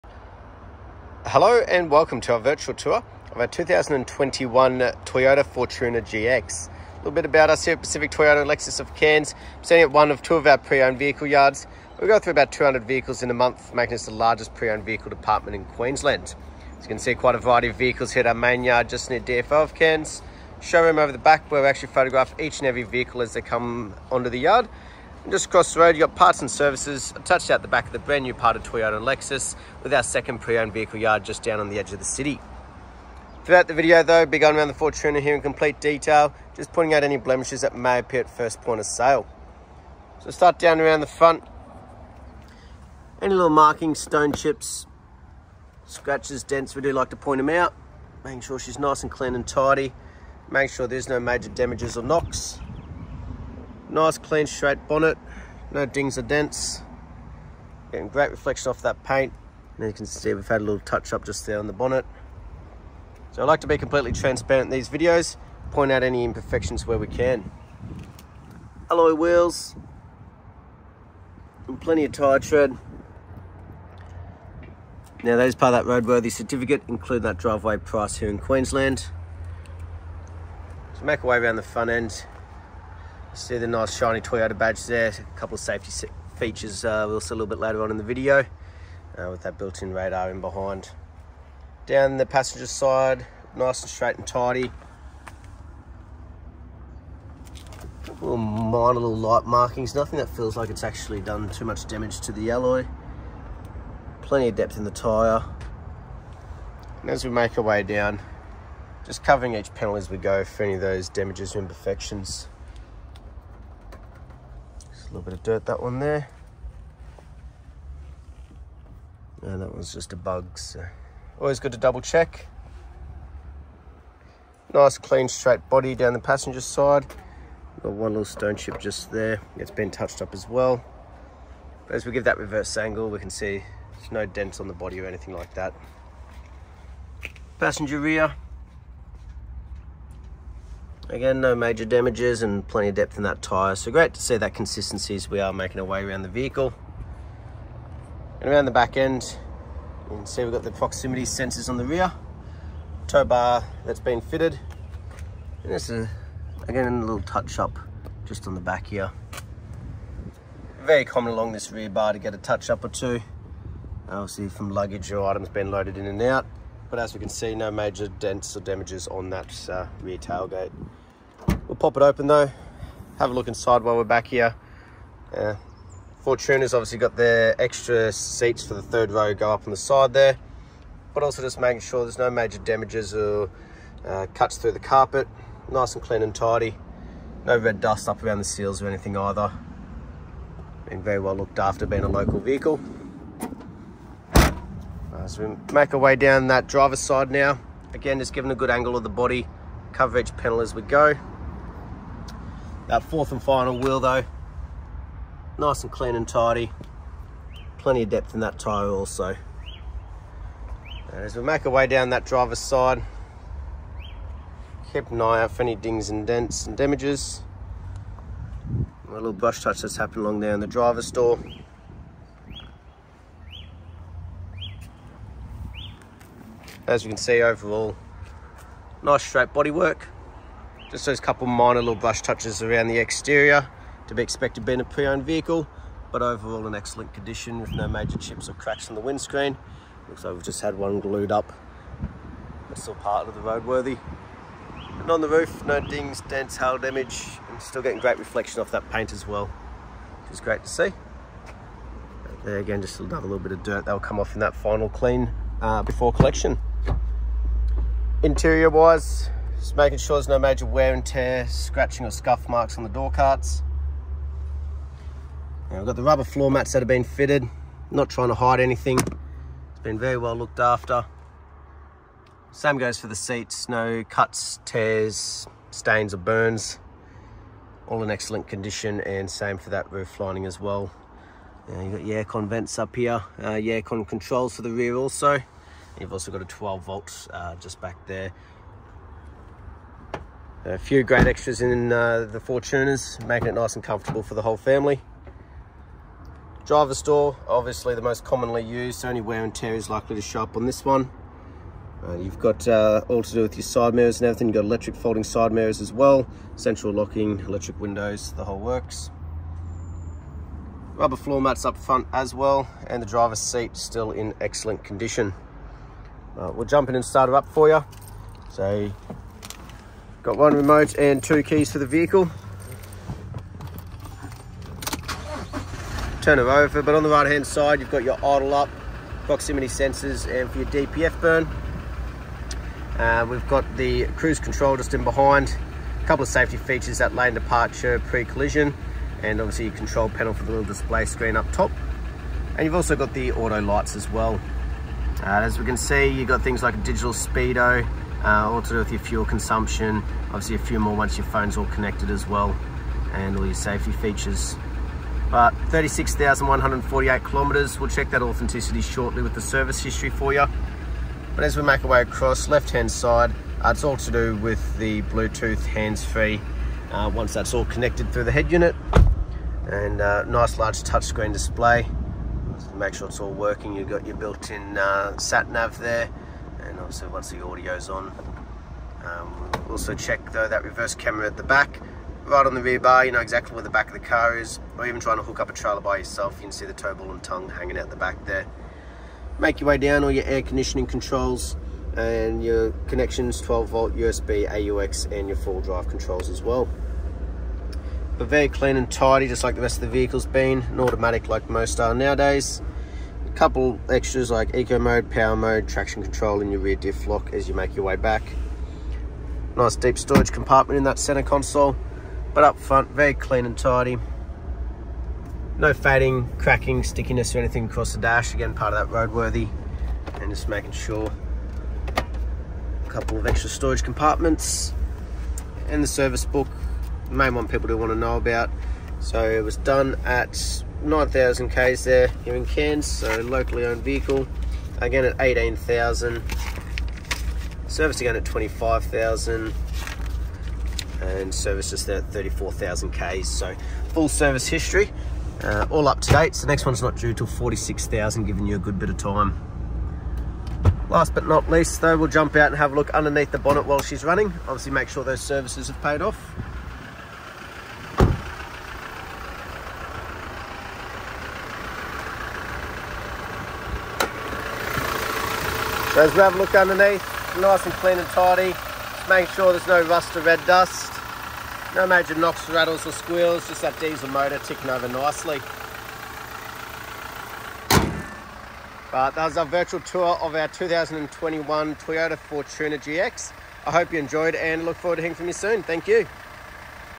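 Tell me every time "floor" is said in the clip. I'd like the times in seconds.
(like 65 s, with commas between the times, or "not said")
266 s, 311 s.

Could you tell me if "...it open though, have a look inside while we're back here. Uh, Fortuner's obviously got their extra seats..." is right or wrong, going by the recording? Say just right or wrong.
right.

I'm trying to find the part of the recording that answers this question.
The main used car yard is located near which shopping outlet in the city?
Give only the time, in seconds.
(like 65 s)
18 s.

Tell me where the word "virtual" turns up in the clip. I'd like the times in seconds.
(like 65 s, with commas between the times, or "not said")
2 s, 479 s.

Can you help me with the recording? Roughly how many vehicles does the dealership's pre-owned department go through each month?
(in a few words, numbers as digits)
200.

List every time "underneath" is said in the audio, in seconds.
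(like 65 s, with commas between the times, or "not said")
452 s, 466 s.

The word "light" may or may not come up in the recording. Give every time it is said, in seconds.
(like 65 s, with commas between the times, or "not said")
99 s, 343 s.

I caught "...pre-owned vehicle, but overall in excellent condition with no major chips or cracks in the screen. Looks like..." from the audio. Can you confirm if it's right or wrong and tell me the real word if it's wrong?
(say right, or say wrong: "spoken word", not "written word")
wrong: "windscreen", not "screen".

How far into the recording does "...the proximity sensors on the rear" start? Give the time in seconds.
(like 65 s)
150 s.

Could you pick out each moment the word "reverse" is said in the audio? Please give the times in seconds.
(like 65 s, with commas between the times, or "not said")
132 s, 380 s.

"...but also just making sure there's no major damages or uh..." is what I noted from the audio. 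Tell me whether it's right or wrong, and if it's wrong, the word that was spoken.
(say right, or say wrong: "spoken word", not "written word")
right.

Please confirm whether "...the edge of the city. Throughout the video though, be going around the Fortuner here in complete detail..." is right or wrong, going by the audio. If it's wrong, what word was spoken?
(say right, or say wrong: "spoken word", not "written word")
right.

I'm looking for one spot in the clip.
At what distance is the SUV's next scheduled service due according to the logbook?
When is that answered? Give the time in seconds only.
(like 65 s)
447 s.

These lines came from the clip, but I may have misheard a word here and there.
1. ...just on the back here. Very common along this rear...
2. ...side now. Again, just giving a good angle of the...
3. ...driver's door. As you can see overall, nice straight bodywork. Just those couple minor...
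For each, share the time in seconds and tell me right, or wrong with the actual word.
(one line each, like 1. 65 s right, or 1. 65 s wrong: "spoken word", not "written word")
1. 158 s right
2. 196 s right
3. 220 s right.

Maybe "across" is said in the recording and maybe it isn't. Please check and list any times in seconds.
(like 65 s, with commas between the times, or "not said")
25 s, 362 s, 417 s.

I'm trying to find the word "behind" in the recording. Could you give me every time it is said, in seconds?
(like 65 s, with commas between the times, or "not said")
90 s, 335 s.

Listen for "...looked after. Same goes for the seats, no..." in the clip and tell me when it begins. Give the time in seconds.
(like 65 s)
270 s.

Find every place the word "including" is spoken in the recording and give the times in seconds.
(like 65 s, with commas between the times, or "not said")
76 s.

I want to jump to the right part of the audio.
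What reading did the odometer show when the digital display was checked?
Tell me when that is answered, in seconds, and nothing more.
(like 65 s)
355 s.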